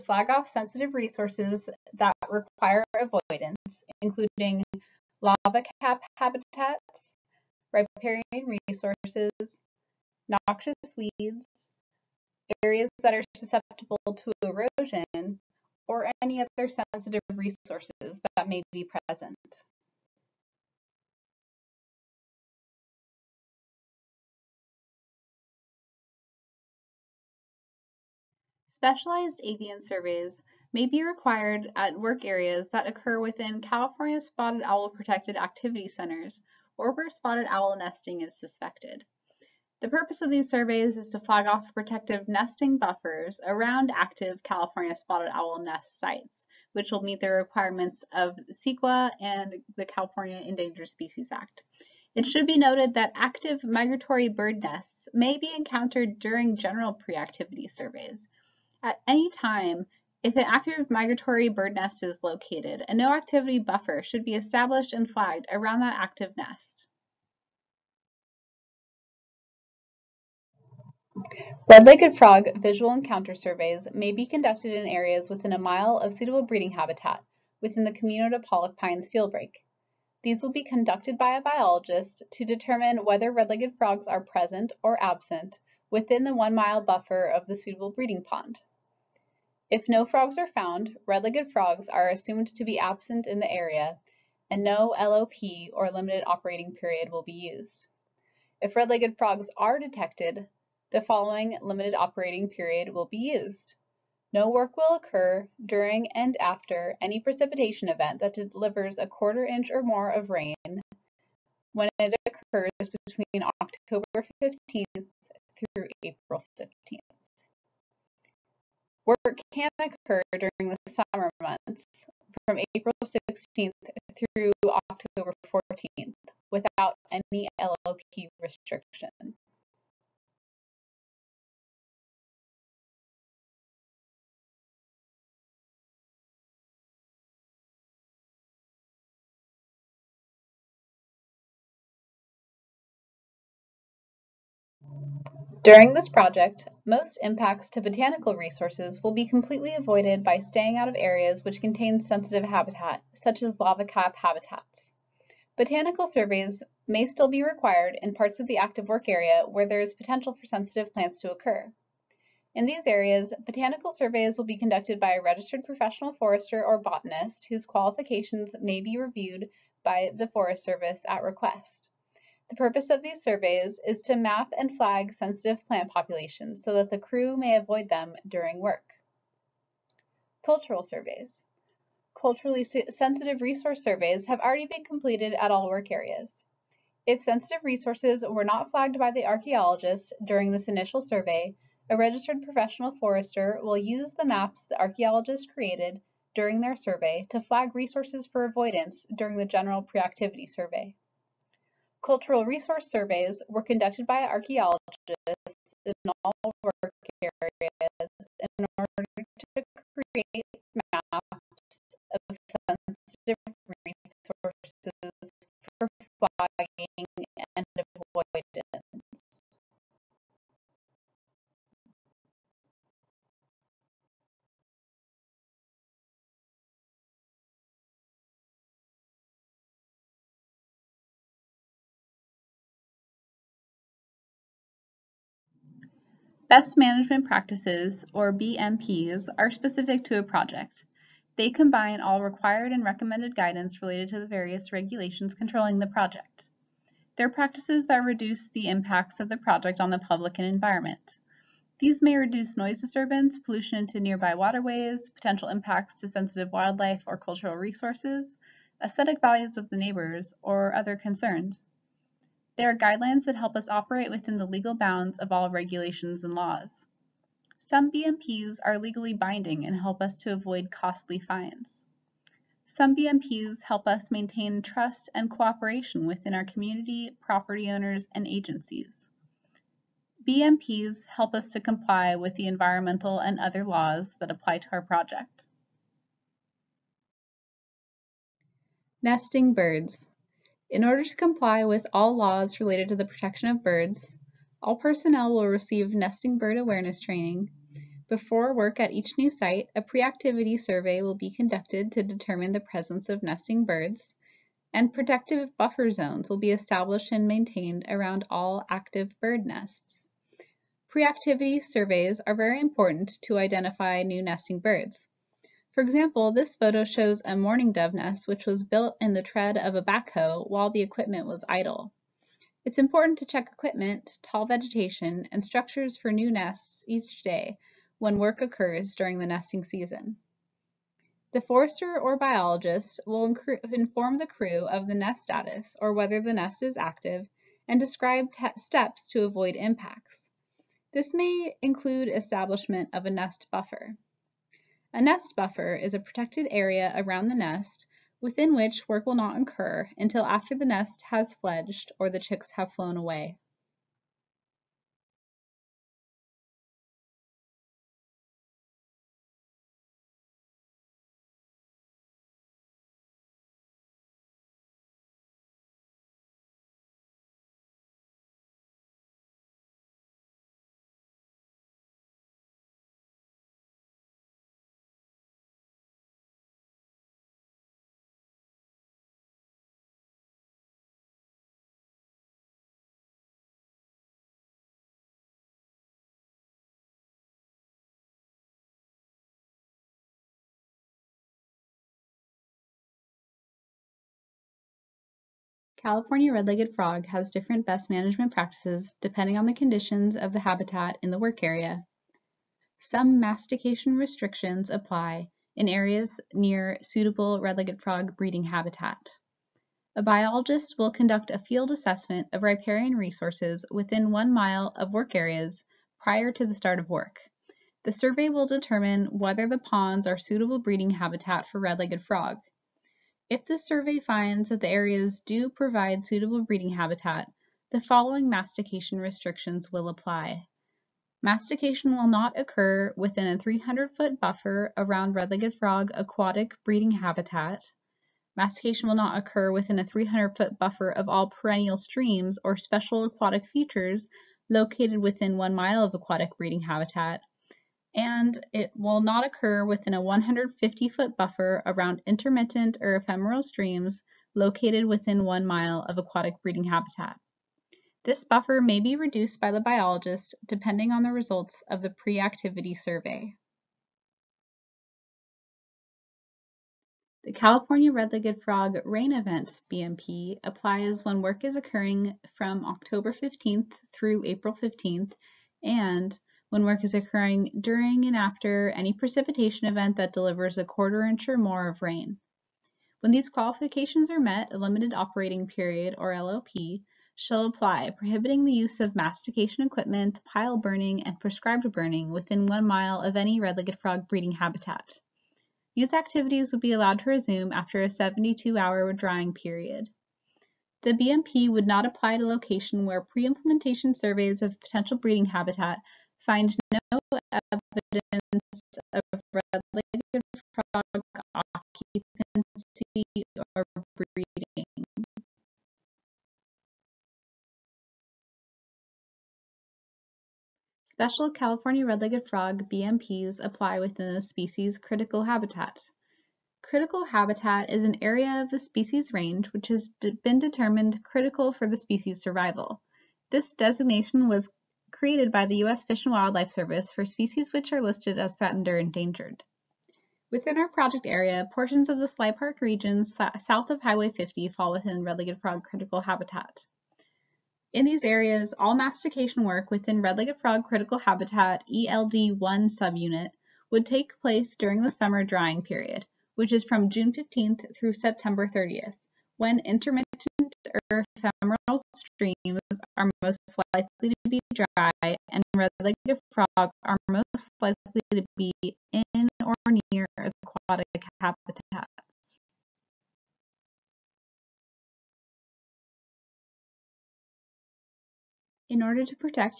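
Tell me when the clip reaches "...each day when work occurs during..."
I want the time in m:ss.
5:26.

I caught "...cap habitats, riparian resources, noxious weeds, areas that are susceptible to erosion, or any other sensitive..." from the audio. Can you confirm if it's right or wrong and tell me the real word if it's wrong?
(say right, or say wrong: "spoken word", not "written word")
right.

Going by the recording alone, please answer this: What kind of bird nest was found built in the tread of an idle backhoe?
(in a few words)
mourning dove.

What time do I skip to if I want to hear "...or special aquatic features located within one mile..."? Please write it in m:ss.
7:22.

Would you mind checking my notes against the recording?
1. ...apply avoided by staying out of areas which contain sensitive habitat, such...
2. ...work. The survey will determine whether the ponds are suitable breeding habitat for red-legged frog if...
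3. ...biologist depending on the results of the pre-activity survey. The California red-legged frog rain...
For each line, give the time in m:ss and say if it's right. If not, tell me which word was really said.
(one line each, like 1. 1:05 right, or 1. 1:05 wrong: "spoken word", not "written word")
1. 2:29 wrong: "completely", not "apply"
2. 6:56 right
3. 7:39 right.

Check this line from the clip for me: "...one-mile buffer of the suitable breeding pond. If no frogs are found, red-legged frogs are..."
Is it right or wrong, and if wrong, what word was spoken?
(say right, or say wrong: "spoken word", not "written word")
right.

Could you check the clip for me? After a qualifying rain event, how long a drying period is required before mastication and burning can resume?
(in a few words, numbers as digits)
72 hours.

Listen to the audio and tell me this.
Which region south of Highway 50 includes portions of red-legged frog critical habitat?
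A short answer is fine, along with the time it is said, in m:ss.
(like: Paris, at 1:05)
Sly Park, at 9:02.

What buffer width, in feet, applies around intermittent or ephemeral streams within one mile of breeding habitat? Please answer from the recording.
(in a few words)
150.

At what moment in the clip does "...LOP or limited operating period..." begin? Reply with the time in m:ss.
1:34.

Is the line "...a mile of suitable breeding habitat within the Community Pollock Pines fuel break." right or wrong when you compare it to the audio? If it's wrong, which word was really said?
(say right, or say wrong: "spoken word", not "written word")
right.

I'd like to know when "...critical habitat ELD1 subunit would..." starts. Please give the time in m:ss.
9:10.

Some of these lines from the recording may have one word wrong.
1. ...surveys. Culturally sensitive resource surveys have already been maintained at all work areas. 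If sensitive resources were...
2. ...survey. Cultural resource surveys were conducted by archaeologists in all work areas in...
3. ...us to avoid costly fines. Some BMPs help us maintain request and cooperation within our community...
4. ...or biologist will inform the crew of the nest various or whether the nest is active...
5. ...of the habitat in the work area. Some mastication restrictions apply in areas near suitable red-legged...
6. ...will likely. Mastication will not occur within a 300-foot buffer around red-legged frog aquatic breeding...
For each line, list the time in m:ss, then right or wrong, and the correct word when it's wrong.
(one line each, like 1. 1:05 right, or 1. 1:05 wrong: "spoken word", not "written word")
1. 3:00 wrong: "completed", not "maintained"
2. 3:20 right
3. 4:30 wrong: "trust", not "request"
4. 5:31 wrong: "status", not "various"
5. 6:40 right
6. 7:09 wrong: "apply", not "likely".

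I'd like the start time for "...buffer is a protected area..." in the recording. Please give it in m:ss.
5:45.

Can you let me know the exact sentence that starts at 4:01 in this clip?
They combine all required and recommended guidance related to the various regulations controlling the project.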